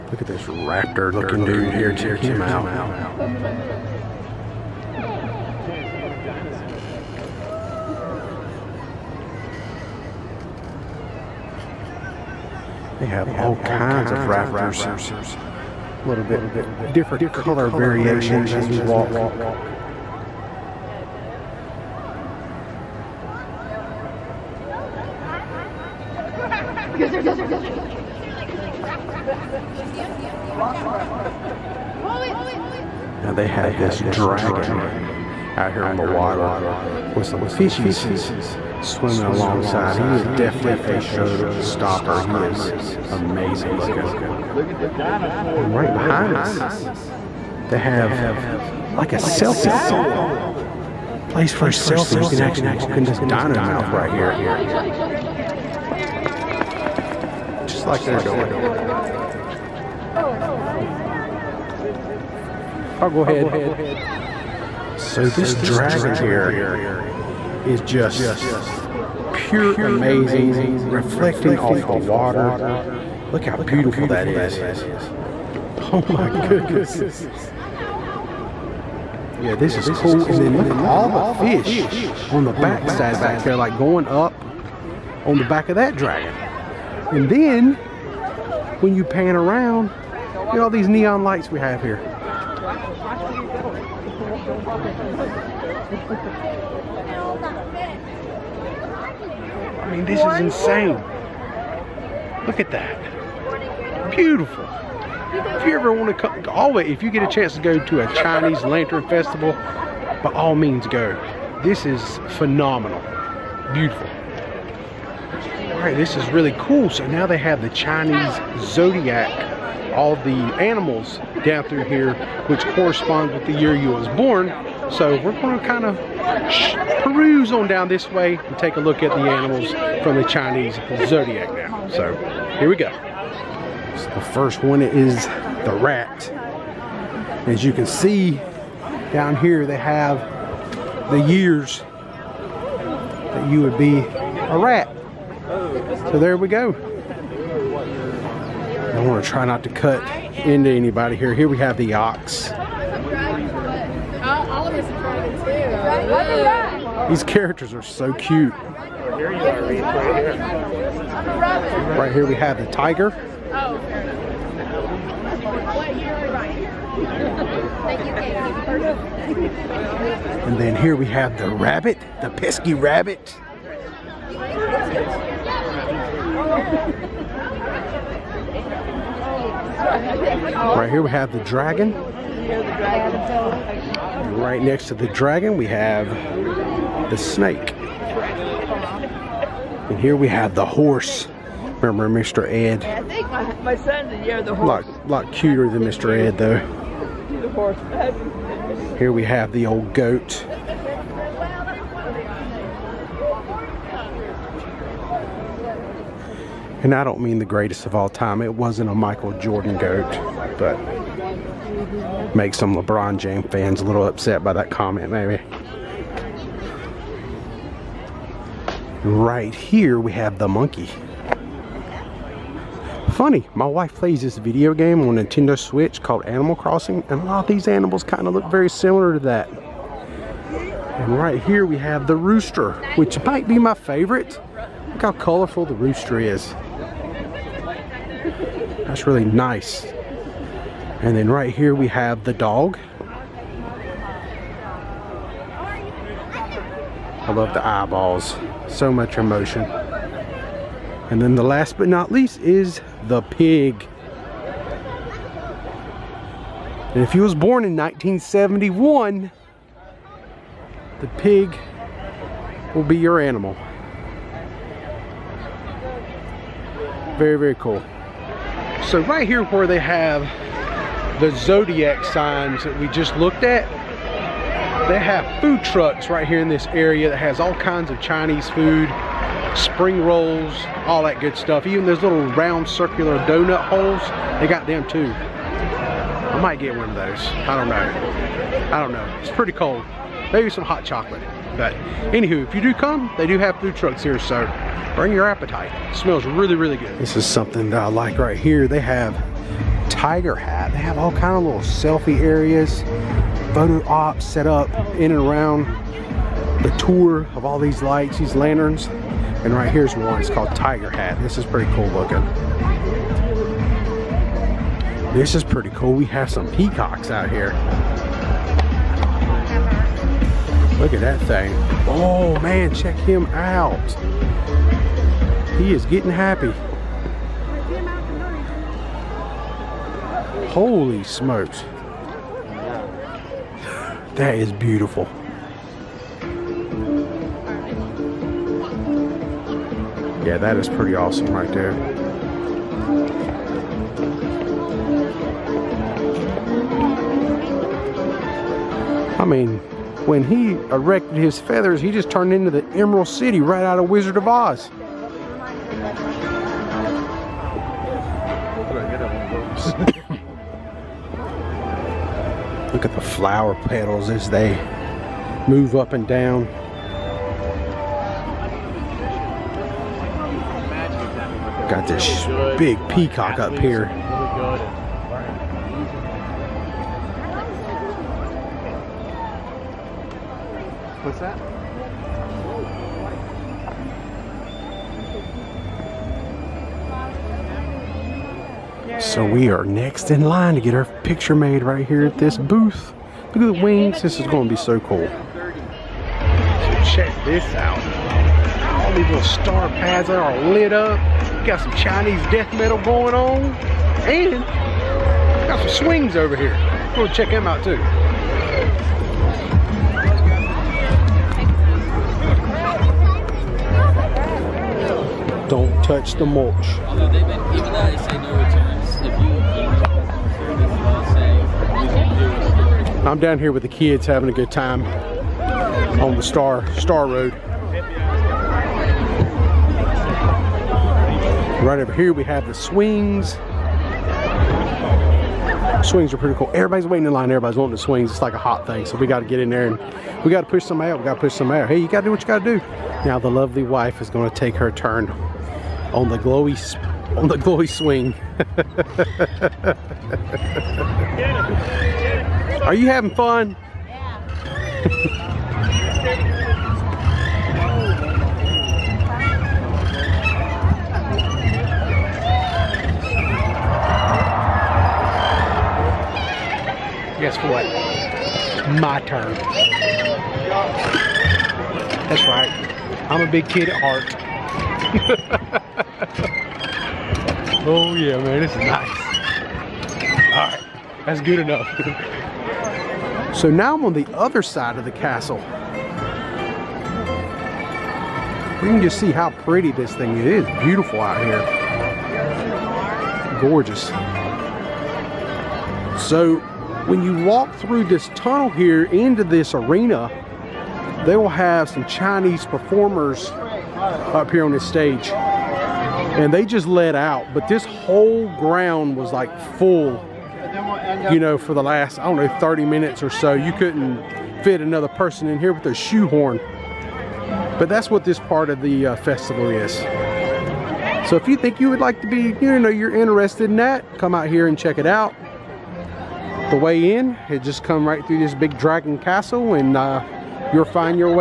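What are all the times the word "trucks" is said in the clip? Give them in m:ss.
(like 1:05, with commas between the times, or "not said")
4:35, 4:53.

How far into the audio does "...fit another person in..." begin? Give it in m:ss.
8:34.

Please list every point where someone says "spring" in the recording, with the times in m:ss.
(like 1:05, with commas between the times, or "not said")
4:39.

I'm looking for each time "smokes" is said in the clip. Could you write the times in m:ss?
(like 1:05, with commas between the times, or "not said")
5:31.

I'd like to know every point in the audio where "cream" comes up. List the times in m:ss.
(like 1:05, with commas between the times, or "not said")
not said.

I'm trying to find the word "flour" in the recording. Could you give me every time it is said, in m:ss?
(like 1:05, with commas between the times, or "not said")
not said.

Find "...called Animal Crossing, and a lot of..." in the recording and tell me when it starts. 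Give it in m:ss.
3:46.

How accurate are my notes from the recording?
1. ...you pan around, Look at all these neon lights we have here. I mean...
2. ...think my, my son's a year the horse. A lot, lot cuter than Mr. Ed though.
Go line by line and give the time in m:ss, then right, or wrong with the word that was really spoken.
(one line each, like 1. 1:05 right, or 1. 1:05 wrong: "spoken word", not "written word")
1. 1:28 right
2. 3:13 right.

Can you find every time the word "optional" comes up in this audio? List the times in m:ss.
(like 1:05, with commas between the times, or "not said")
not said.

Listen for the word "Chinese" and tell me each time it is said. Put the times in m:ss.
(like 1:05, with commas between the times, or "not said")
1:48, 1:57, 2:10, 4:38, 6:41, 8:21.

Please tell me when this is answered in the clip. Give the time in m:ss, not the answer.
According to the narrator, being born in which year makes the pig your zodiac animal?
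4:17.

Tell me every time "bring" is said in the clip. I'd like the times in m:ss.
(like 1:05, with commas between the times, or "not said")
4:54.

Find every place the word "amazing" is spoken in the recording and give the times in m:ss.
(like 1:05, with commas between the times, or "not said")
0:43, 1:09.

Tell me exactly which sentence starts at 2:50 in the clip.
And then here we have the rabbit, the pesky rabbit.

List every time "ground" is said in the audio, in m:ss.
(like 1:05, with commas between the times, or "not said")
8:28.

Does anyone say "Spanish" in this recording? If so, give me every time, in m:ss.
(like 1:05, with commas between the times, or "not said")
not said.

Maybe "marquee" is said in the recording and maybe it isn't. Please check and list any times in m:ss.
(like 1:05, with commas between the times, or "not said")
0:27.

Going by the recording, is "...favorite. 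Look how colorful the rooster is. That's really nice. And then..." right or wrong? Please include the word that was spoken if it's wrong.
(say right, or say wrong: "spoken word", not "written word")
right.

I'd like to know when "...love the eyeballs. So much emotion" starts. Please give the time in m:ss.
4:07.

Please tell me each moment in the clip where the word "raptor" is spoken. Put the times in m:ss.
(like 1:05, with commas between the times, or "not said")
0:00, 0:14.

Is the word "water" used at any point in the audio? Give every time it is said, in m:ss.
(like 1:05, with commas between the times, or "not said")
0:36, 1:11.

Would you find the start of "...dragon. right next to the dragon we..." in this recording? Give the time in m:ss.
3:01.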